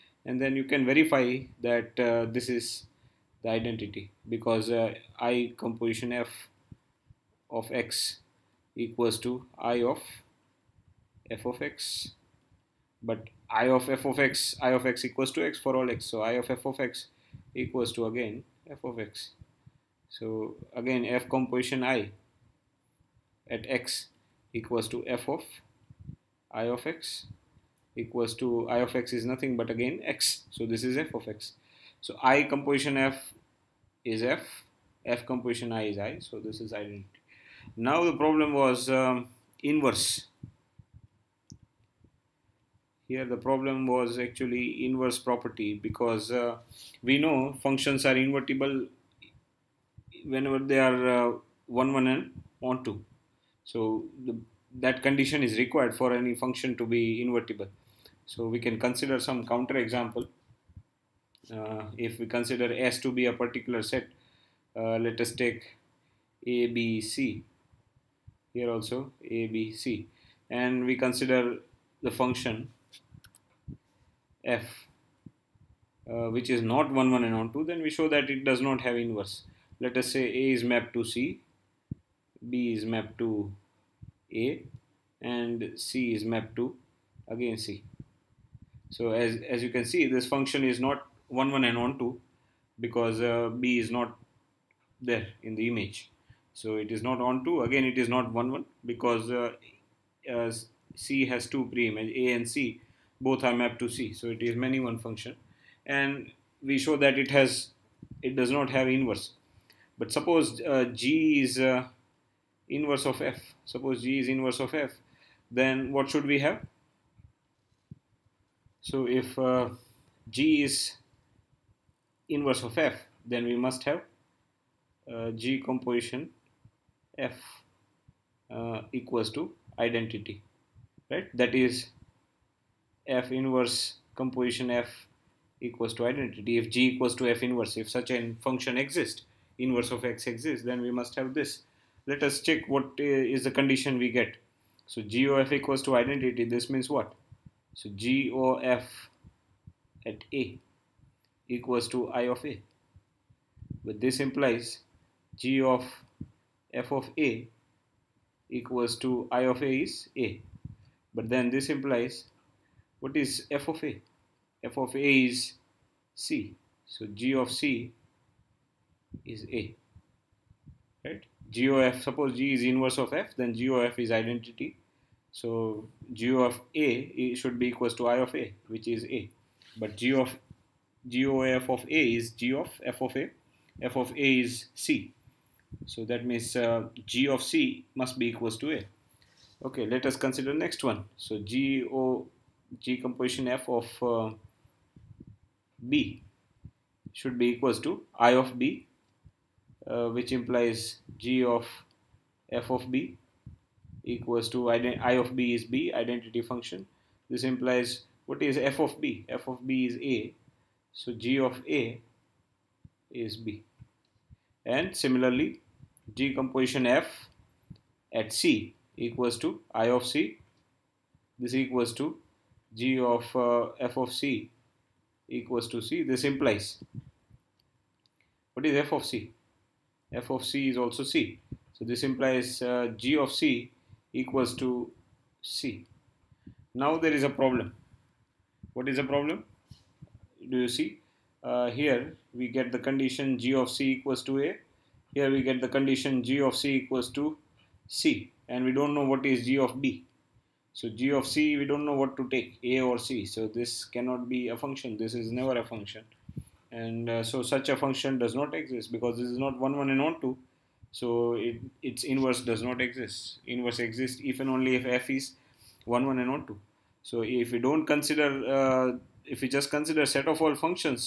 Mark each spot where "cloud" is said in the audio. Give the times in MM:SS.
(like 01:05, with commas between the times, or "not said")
not said.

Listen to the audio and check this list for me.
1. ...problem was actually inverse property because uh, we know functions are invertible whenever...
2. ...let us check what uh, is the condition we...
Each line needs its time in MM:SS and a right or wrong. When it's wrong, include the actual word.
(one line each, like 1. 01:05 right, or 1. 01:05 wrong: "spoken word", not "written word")
1. 00:43 right
2. 02:22 right.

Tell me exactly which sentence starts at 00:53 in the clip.
So the, that condition is required for any function to be invertible.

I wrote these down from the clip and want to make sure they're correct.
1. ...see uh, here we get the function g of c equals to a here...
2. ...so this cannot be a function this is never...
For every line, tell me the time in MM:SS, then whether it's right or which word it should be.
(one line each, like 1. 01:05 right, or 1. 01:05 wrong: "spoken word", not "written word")
1. 04:00 wrong: "condition", not "function"
2. 04:13 right.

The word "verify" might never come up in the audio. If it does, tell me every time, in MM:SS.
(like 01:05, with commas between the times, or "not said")
00:00.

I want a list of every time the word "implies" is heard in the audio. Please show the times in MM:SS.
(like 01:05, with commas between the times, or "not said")
02:34, 02:41, 03:20, 03:27, 03:46, 03:52.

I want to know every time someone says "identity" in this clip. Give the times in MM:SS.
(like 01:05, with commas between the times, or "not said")
00:03, 00:36, 02:09, 02:16, 02:25, 02:54, 03:25.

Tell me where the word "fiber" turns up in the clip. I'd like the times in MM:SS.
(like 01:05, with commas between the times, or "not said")
not said.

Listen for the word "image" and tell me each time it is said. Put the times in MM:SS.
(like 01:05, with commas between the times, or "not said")
01:35, 01:41.